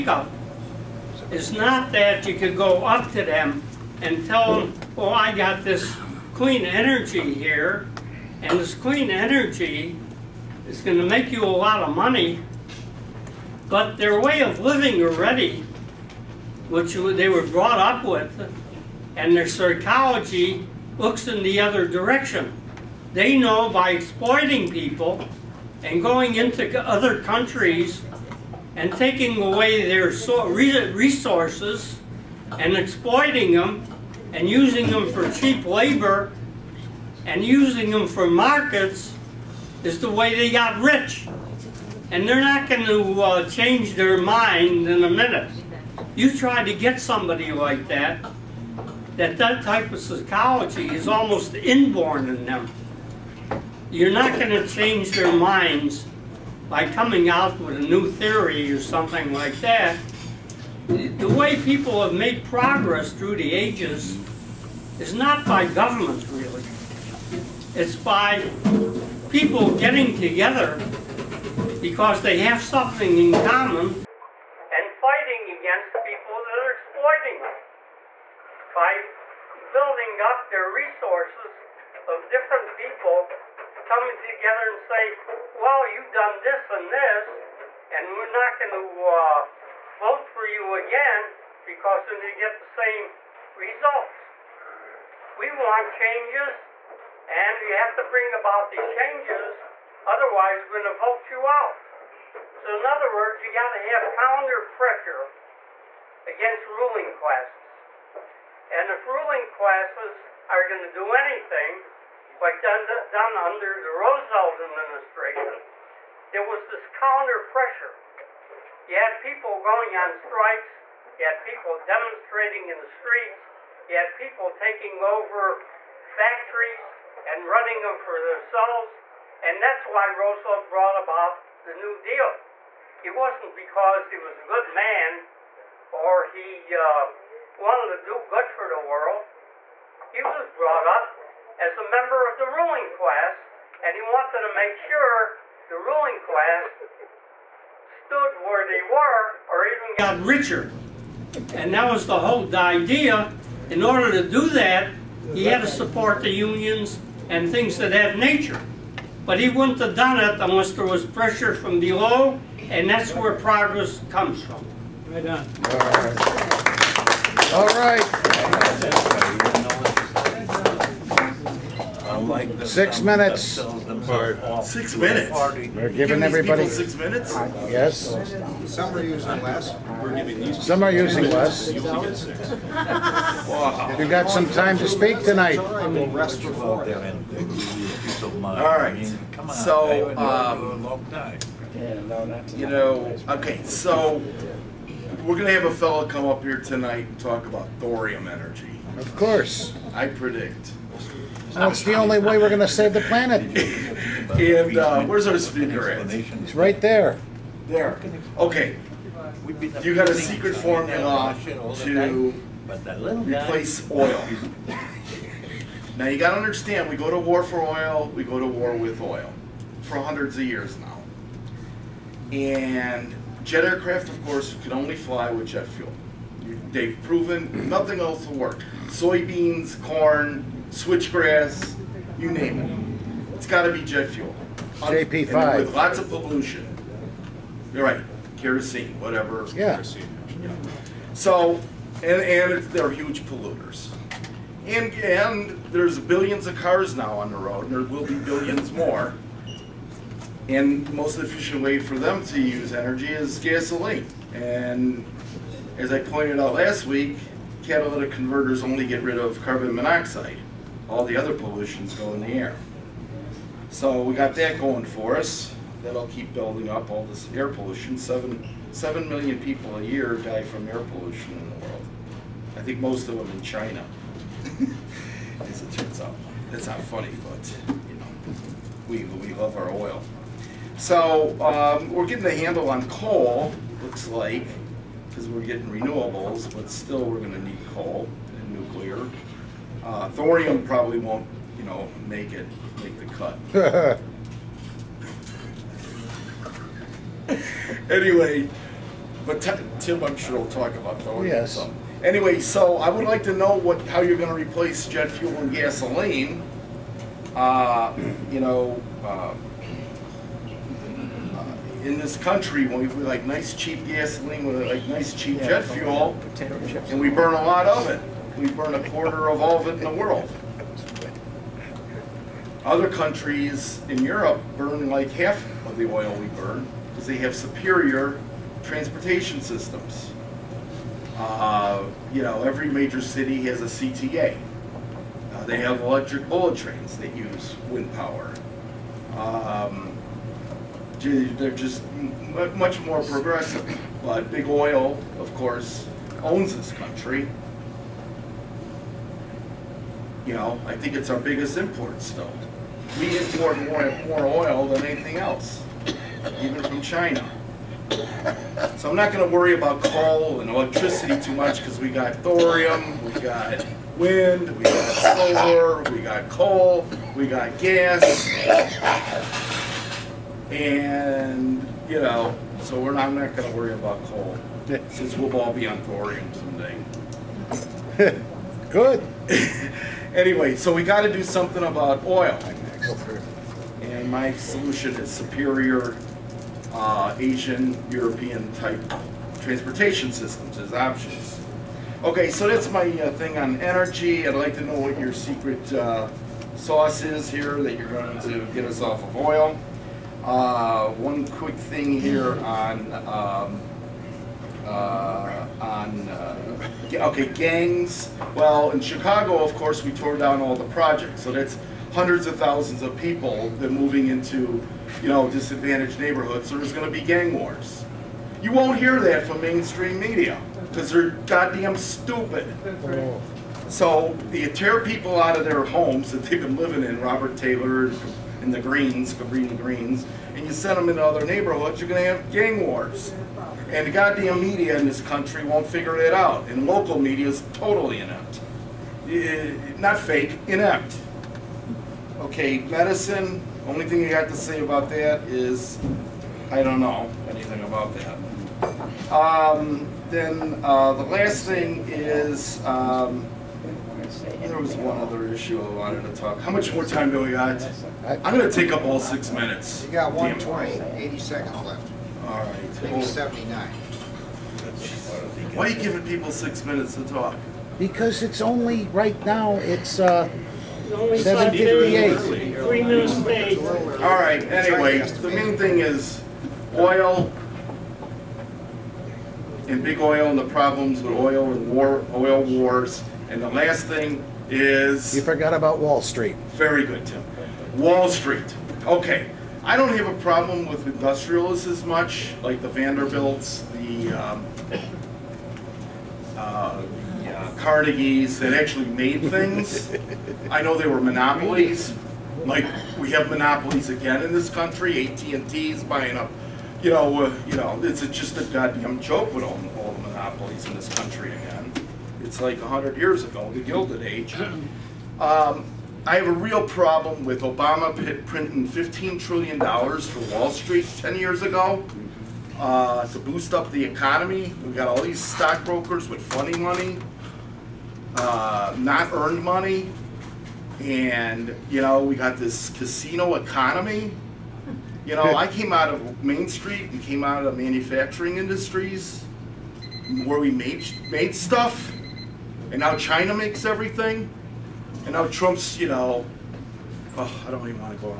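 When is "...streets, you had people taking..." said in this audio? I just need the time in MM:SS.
02:02.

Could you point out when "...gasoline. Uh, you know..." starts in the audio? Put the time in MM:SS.
05:05.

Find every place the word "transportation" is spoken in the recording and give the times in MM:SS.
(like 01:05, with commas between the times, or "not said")
05:28, 06:29.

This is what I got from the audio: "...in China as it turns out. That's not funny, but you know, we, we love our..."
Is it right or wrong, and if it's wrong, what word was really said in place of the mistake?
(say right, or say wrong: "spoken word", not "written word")
right.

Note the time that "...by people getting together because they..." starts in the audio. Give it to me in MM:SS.
01:07.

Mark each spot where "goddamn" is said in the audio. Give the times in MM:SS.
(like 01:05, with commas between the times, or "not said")
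07:01, 07:13, 08:28.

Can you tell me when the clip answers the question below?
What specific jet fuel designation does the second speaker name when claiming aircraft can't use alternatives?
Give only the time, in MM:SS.
03:54.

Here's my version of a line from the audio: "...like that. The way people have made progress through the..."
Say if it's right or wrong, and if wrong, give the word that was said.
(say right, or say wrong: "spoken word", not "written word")
right.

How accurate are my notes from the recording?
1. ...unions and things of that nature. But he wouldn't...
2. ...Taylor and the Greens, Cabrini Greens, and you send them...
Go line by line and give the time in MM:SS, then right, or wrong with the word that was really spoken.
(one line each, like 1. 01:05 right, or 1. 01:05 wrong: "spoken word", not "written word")
1. 02:36 right
2. 07:07 right.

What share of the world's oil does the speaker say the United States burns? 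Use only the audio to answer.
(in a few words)
A quarter.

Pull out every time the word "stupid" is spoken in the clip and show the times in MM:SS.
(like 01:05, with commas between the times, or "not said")
07:01.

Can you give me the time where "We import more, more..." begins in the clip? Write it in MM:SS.
05:52.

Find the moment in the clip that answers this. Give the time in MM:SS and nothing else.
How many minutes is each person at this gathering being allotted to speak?
02:52.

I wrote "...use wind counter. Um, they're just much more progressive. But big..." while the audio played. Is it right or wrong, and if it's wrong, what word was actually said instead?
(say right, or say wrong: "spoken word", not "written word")
wrong: "power", not "counter".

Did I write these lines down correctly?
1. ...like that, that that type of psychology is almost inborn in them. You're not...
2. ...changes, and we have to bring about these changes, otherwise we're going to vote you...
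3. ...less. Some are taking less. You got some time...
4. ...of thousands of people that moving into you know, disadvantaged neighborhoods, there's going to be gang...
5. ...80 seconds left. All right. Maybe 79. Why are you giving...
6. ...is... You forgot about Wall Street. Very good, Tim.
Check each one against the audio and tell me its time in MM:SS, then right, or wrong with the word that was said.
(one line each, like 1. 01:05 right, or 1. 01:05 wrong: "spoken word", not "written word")
1. 00:47 right
2. 01:35 right
3. 02:59 wrong: "using", not "taking"
4. 06:52 right
5. 07:40 right
6. 08:04 right.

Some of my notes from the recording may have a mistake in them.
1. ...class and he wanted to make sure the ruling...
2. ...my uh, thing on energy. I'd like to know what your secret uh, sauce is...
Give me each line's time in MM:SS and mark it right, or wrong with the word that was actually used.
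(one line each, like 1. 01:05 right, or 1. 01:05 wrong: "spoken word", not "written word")
1. 02:22 right
2. 06:32 right.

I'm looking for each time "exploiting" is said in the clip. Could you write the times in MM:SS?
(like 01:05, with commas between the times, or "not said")
00:23, 00:32, 01:16.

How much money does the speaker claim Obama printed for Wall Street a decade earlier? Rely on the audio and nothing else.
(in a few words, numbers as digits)
$15 trillion.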